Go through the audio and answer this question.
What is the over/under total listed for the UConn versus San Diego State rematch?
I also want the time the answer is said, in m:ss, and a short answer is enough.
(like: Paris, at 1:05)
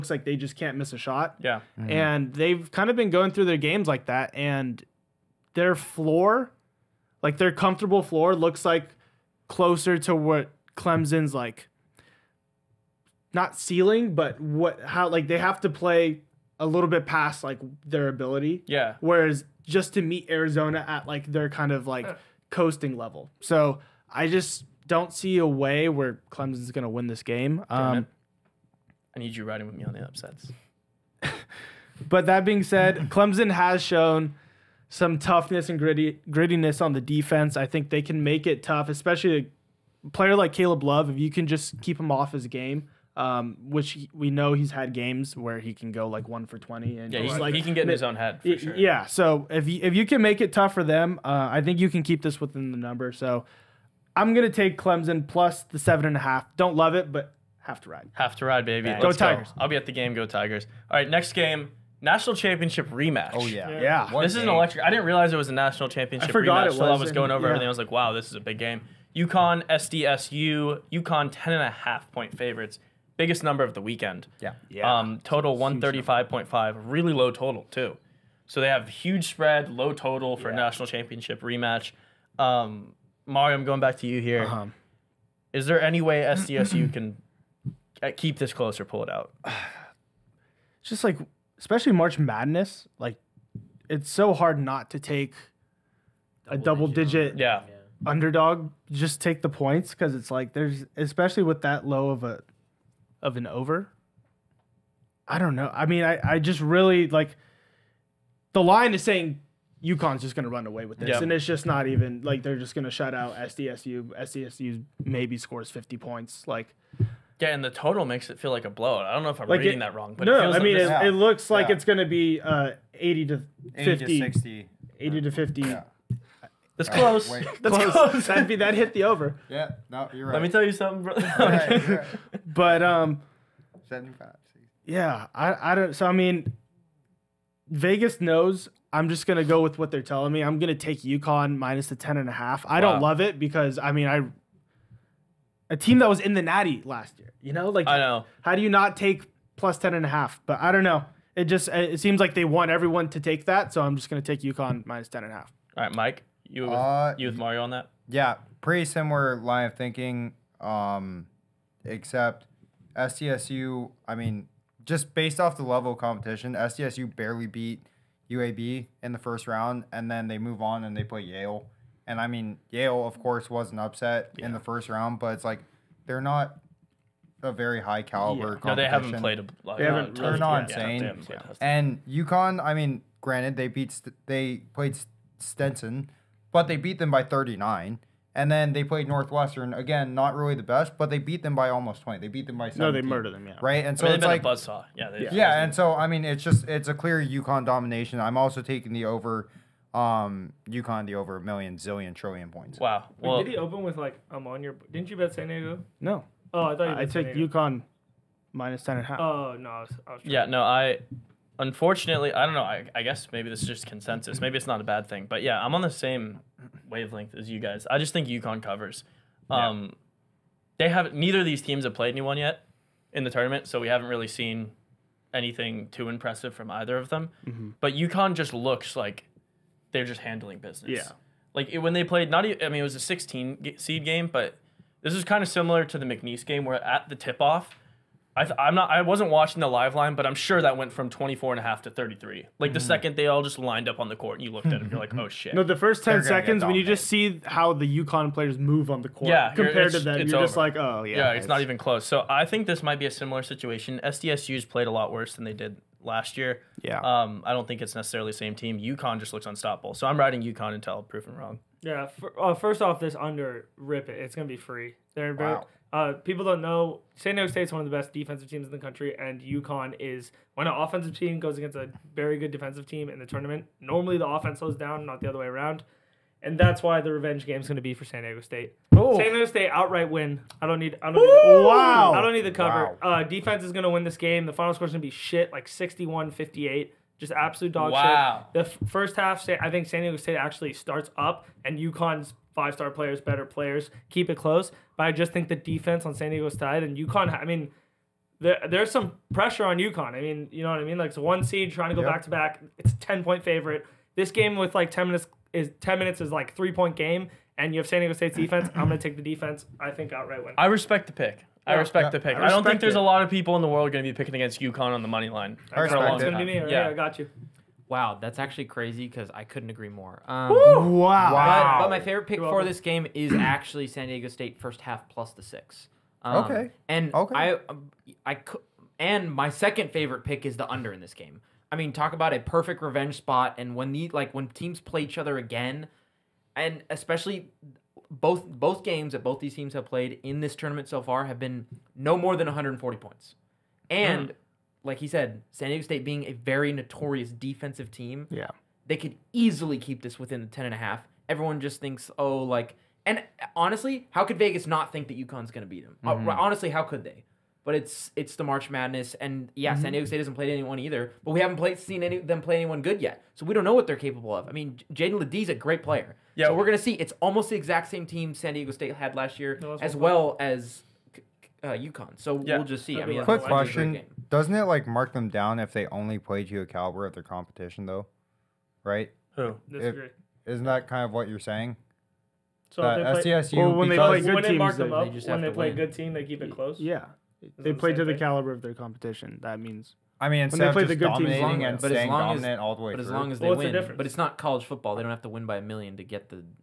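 135.5, at 1:15.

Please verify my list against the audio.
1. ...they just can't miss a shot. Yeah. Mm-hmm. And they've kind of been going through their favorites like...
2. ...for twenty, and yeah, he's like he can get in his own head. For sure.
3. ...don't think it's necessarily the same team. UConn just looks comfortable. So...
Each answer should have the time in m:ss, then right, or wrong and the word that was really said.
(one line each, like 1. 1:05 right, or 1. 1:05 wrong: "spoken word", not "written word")
1. 0:00 wrong: "games", not "favorites"
2. 0:46 right
3. 4:17 wrong: "unstoppable", not "comfortable".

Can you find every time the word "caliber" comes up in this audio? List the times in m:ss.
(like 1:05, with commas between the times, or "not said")
2:58, 6:16, 6:28.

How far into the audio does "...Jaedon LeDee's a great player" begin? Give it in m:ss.
6:04.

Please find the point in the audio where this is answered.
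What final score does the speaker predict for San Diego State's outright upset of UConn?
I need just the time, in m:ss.
4:45.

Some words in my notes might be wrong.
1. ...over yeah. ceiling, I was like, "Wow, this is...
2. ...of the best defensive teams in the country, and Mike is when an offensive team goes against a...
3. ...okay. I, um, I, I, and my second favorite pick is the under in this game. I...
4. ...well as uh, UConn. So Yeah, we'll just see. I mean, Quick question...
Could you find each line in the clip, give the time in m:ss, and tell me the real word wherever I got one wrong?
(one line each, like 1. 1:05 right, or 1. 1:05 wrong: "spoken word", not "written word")
1. 1:07 wrong: "everything", not "ceiling"
2. 4:27 wrong: "UConn", not "Mike"
3. 5:27 right
4. 6:09 right.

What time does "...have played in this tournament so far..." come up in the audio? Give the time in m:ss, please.
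5:39.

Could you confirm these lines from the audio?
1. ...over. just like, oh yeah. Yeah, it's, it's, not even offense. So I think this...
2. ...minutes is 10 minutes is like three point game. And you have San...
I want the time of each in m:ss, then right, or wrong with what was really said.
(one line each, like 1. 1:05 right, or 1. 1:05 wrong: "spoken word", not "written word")
1. 4:10 wrong: "close", not "offense"
2. 5:05 right.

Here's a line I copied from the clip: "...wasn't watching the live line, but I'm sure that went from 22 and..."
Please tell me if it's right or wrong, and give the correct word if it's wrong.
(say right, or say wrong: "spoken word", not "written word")
wrong: "24", not "22".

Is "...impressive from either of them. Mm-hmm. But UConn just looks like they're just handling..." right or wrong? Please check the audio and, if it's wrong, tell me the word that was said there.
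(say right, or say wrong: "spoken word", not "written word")
right.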